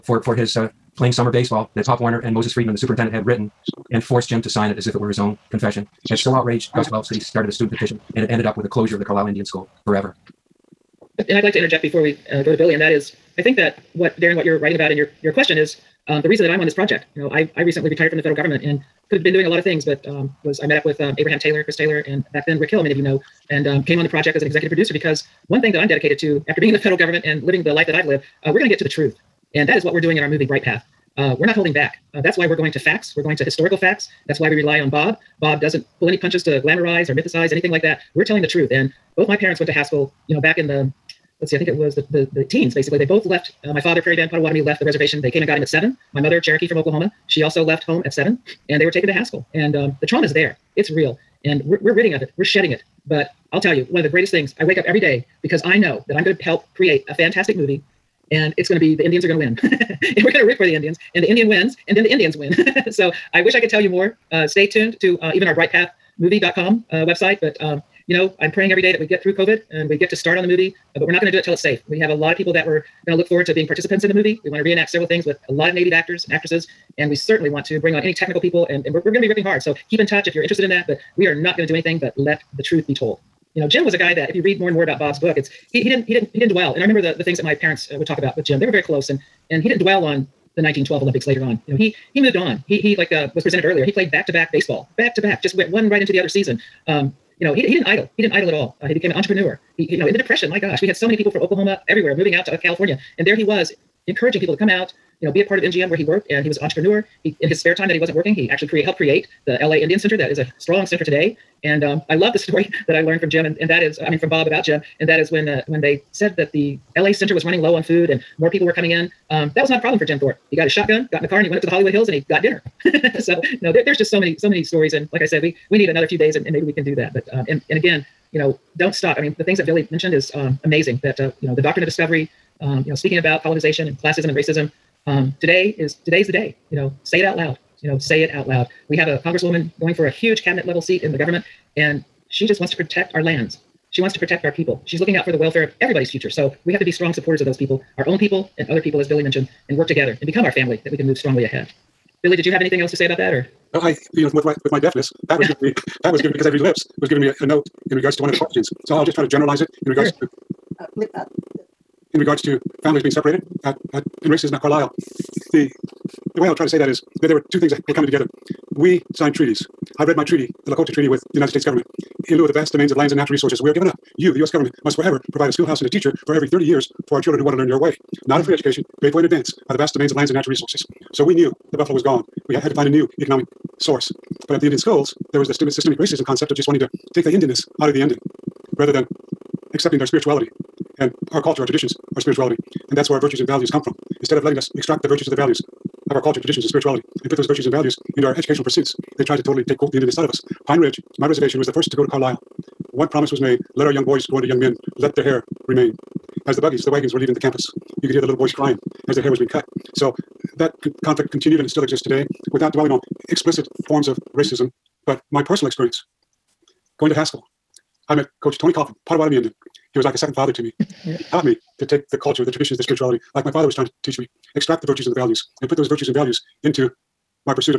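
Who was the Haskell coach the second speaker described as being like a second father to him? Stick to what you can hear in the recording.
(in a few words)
Tony Coffin.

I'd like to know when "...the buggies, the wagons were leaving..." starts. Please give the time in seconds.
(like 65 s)
206 s.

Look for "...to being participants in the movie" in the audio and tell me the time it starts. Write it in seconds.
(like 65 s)
73 s.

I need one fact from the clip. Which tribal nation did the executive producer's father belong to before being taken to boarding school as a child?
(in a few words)
Prairie Band Potawatomi.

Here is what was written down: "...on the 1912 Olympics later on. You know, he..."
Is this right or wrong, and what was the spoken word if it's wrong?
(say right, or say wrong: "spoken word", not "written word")
right.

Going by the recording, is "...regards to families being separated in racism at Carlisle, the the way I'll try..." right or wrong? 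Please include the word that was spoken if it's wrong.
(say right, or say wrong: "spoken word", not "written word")
right.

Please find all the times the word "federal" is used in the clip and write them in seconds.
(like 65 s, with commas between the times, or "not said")
18 s, 26 s.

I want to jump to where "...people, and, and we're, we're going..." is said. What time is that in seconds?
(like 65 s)
78 s.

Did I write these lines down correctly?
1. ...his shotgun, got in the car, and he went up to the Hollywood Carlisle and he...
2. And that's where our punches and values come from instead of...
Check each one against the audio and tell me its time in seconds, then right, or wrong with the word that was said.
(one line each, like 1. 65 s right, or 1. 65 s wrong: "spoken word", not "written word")
1. 120 s wrong: "Hills", not "Carlisle"
2. 192 s wrong: "virtues", not "punches".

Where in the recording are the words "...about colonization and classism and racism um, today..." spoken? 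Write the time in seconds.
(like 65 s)
133 s.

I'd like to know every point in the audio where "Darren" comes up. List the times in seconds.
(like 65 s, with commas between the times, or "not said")
14 s.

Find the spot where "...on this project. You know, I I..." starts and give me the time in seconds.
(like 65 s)
16 s.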